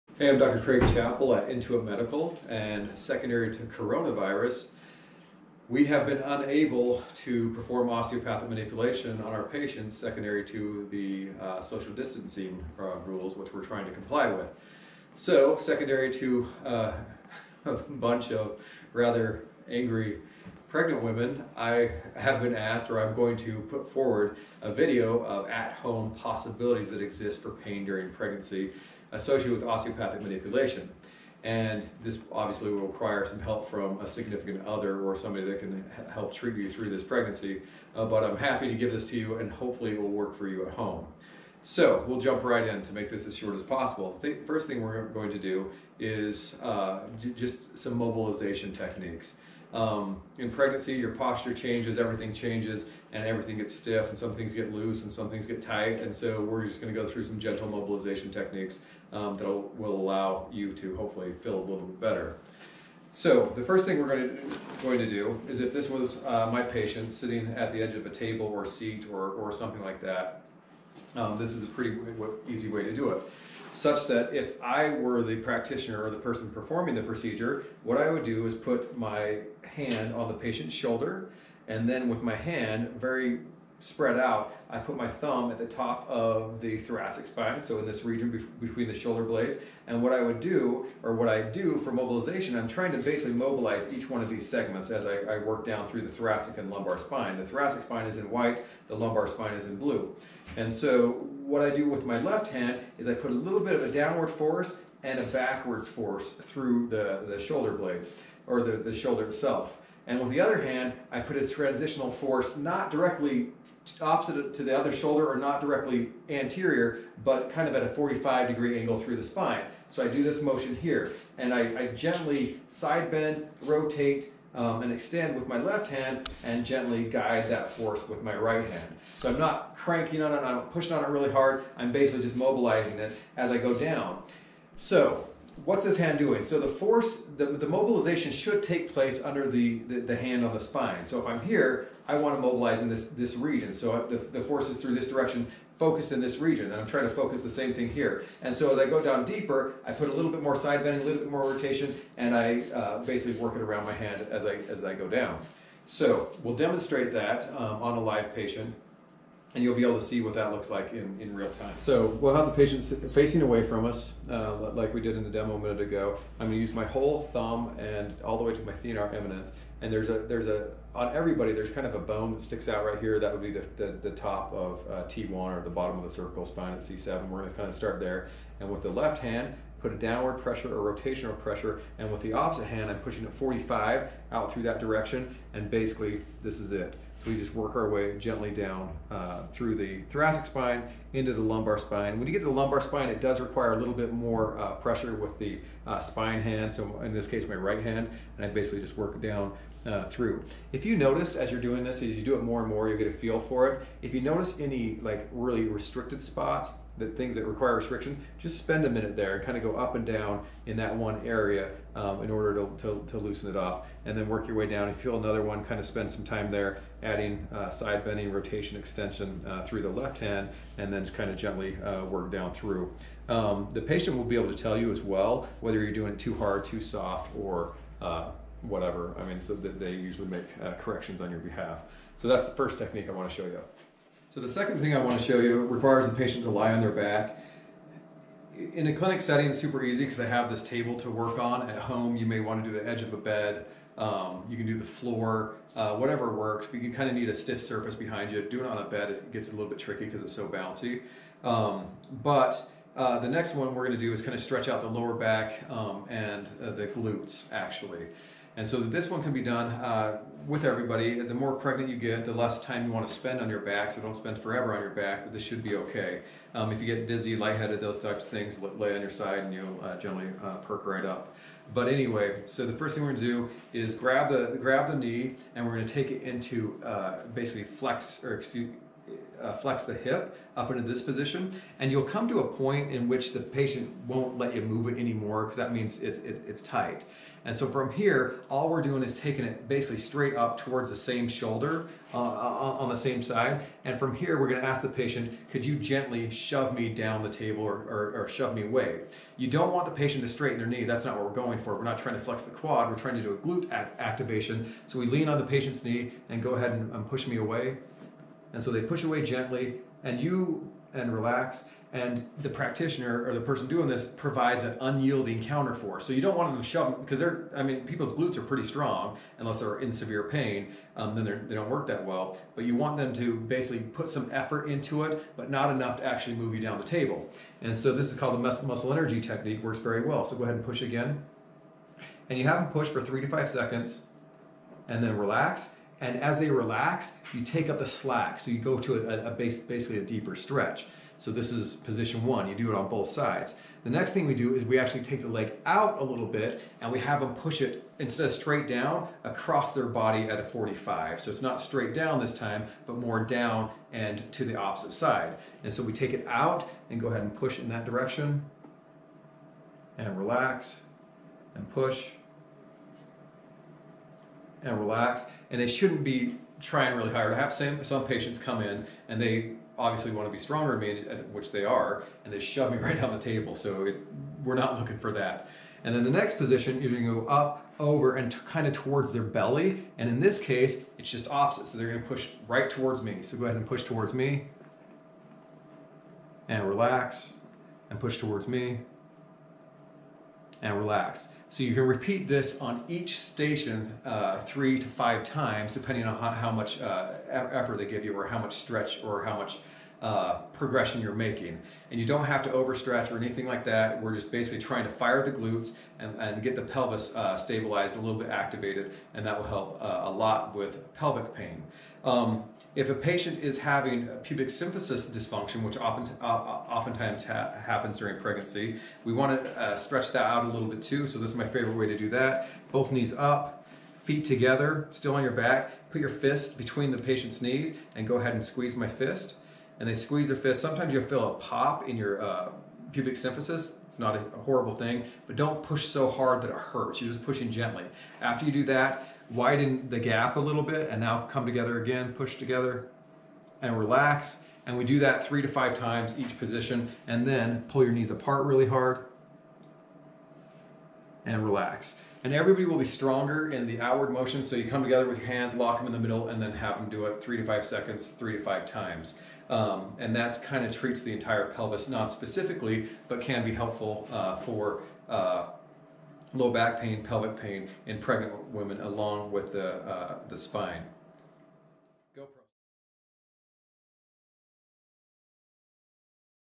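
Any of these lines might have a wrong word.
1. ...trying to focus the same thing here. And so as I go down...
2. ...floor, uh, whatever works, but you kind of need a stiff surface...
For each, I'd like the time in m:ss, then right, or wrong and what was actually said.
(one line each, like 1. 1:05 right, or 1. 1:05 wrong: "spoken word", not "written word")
1. 2:26 right
2. 4:04 right.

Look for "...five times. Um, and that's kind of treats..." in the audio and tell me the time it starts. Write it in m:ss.
7:38.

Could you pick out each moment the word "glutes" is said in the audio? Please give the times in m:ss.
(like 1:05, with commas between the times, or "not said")
4:16, 5:03, 5:18, 6:45.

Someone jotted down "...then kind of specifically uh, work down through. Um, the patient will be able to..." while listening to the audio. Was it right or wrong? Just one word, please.
wrong.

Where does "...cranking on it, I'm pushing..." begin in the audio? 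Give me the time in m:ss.
2:09.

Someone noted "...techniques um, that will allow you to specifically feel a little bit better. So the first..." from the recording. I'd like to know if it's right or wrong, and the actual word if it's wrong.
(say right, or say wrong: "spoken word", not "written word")
wrong: "hopefully", not "specifically".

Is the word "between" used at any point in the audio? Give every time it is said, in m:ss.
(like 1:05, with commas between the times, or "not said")
1:28, 7:06.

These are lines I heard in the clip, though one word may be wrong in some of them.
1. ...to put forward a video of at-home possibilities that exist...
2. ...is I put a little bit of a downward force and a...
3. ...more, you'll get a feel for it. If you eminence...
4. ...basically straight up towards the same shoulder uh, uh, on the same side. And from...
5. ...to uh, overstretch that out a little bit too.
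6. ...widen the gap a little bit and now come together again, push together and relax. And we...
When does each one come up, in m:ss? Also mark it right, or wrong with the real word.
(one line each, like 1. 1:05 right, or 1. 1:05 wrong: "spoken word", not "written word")
1. 0:23 right
2. 1:42 right
3. 3:22 wrong: "notice", not "eminence"
4. 4:49 right
5. 6:59 wrong: "stretch", not "overstretch"
6. 7:19 right.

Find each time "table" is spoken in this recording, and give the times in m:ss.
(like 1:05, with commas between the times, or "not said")
1:08, 4:00, 4:57, 5:26, 6:13.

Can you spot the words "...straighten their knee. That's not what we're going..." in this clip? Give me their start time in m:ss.
5:00.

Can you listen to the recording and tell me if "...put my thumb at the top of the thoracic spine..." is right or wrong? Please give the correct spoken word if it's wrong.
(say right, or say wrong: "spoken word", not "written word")
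right.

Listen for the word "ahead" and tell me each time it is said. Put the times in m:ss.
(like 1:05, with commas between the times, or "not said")
5:06, 5:30, 5:57, 6:23, 7:08.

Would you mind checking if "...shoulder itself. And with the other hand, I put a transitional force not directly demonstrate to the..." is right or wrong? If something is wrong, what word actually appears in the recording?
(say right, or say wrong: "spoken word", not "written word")
wrong: "opposite", not "demonstrate".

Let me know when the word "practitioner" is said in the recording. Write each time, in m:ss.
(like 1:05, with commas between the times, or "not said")
1:15, 5:12.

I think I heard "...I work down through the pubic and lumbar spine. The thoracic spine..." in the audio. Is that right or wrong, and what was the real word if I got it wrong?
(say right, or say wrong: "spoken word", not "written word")
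wrong: "thoracic", not "pubic".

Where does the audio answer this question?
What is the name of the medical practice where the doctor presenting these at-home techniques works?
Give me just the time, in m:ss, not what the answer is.
0:01.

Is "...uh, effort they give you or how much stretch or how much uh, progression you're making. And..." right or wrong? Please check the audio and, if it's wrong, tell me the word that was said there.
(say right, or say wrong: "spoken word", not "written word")
right.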